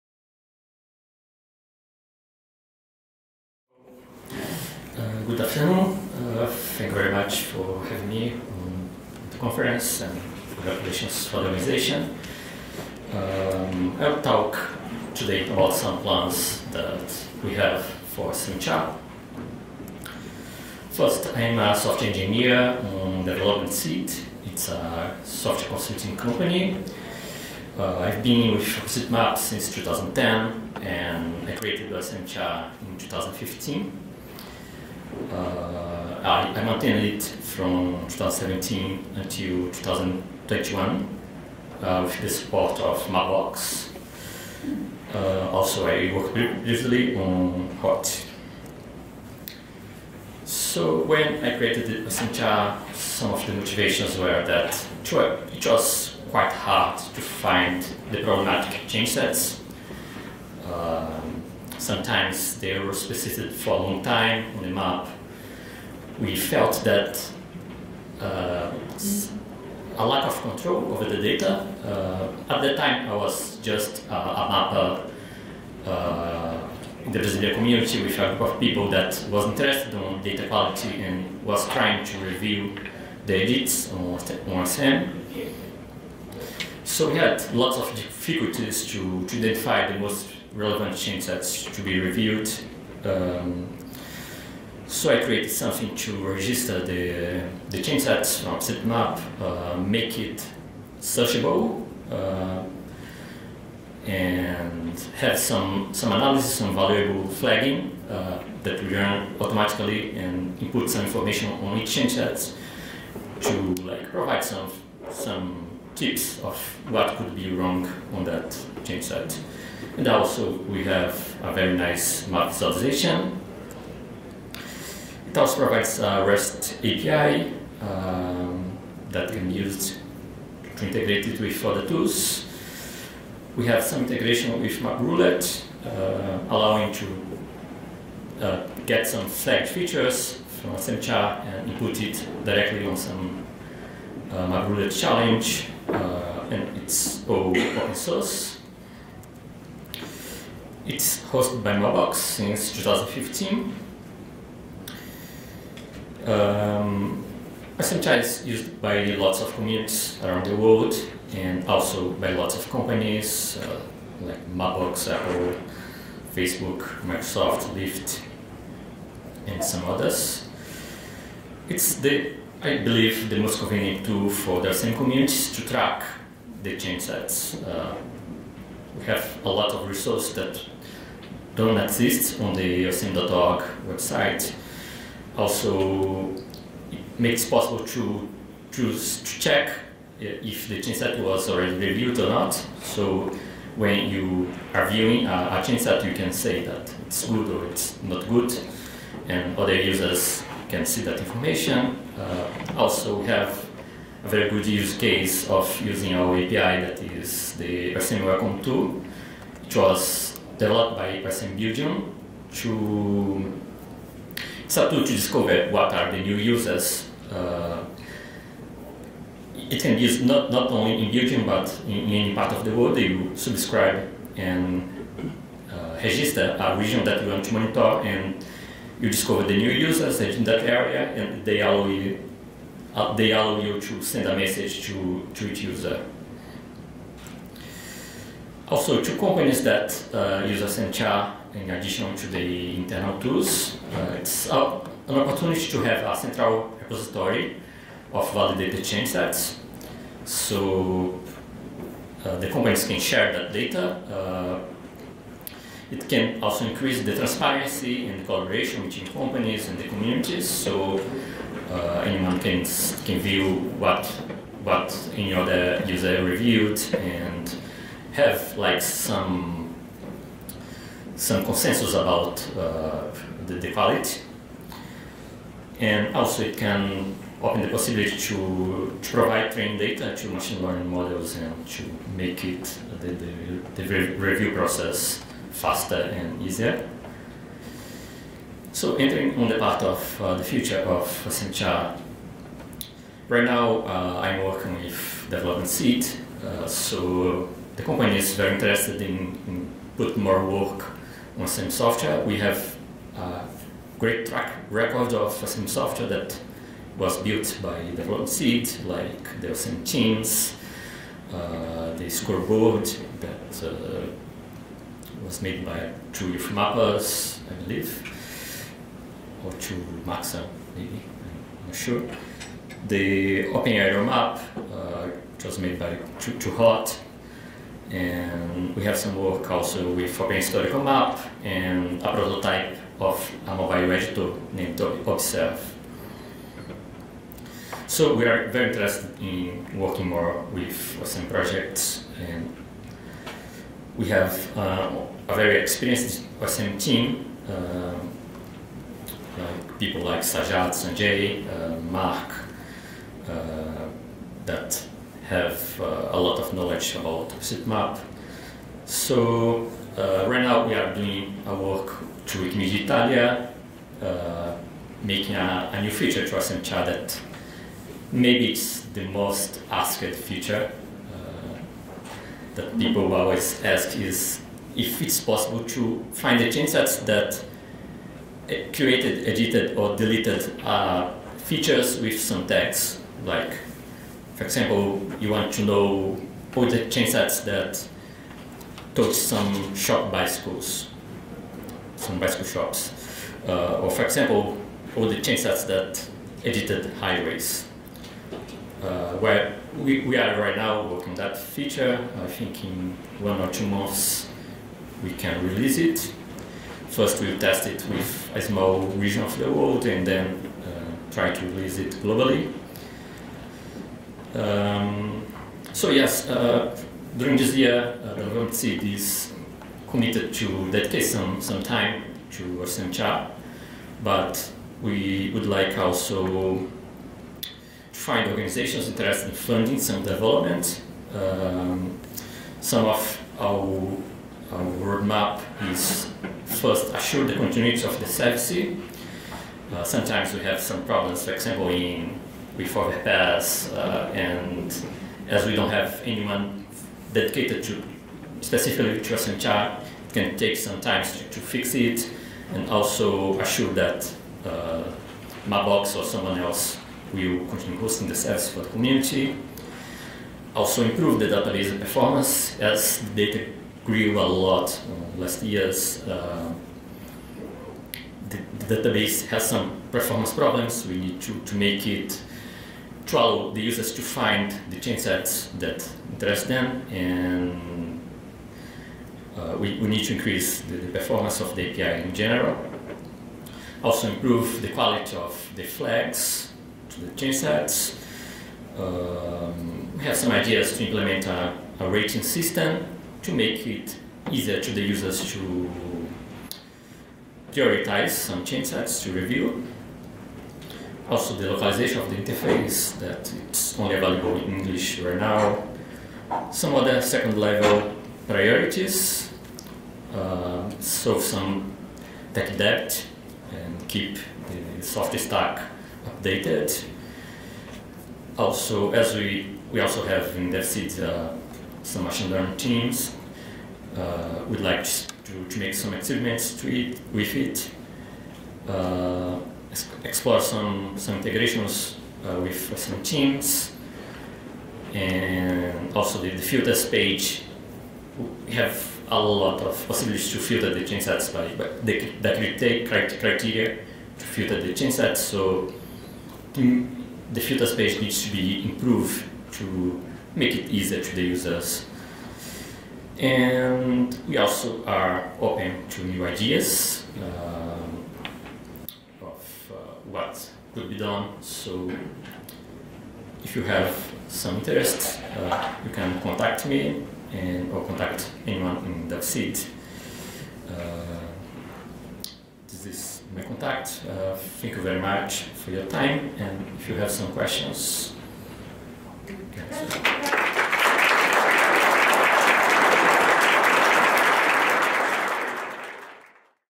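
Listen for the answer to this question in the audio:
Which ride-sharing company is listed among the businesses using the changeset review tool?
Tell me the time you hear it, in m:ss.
2:47.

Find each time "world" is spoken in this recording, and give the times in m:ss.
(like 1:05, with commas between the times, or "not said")
2:40, 3:42, 6:49, 6:58.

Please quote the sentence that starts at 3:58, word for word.
Also, two companies that uh, use Accenture in addition to the internal tools.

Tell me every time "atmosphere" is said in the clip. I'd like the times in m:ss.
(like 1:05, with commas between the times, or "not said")
not said.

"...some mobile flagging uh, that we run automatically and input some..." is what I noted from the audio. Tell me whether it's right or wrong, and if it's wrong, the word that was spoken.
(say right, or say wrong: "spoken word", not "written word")
wrong: "valuable", not "mobile".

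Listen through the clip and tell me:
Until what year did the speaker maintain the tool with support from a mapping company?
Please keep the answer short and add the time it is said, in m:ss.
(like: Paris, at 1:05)
2021, at 0:39.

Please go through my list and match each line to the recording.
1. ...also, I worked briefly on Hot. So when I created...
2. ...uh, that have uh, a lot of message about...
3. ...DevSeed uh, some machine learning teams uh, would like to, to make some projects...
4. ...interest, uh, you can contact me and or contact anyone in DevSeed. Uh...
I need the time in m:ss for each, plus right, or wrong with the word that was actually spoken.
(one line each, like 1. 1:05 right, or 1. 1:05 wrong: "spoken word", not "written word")
1. 0:45 right
2. 5:53 wrong: "knowledge", not "message"
3. 8:40 wrong: "experiments", not "projects"
4. 9:24 right.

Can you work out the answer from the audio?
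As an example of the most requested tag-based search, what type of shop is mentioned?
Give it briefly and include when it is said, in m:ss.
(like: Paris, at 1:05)
bicycle shops, at 6:32.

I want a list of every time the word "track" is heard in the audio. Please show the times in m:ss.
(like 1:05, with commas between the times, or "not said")
2:55, 5:04.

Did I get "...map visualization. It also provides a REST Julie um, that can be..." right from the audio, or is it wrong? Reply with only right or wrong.
wrong.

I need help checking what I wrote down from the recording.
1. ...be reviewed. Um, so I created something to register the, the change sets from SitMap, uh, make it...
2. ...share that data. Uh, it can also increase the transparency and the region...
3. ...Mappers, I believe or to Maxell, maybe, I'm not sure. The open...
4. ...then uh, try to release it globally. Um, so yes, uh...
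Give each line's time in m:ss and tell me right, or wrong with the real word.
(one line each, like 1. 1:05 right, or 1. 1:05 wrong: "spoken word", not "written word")
1. 1:31 right
2. 4:12 wrong: "collaboration", not "region"
3. 5:16 right
4. 6:50 right.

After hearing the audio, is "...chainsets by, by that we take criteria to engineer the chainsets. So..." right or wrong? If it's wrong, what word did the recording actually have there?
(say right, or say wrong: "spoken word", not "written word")
wrong: "filter", not "engineer".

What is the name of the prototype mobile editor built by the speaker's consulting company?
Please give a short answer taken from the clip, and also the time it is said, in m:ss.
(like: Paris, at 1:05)
Observe, at 5:34.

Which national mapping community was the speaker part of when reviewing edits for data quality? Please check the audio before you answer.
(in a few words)
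Brazilian.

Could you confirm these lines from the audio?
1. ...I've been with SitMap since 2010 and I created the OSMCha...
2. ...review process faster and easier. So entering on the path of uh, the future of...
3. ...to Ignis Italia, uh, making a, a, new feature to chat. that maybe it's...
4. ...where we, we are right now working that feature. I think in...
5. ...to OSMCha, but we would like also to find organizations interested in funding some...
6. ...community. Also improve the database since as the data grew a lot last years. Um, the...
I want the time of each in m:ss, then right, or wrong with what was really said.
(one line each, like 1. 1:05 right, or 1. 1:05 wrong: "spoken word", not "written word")
1. 0:27 right
2. 4:44 right
3. 6:02 right
4. 6:39 right
5. 7:02 right
6. 7:38 wrong: "performance", not "since".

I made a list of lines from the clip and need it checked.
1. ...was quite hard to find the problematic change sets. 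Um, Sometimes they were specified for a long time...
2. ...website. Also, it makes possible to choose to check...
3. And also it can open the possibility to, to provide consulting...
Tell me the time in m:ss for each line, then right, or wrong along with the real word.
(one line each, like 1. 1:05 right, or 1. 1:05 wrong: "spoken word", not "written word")
1. 0:55 right
2. 3:03 right
3. 4:35 wrong: "training", not "consulting".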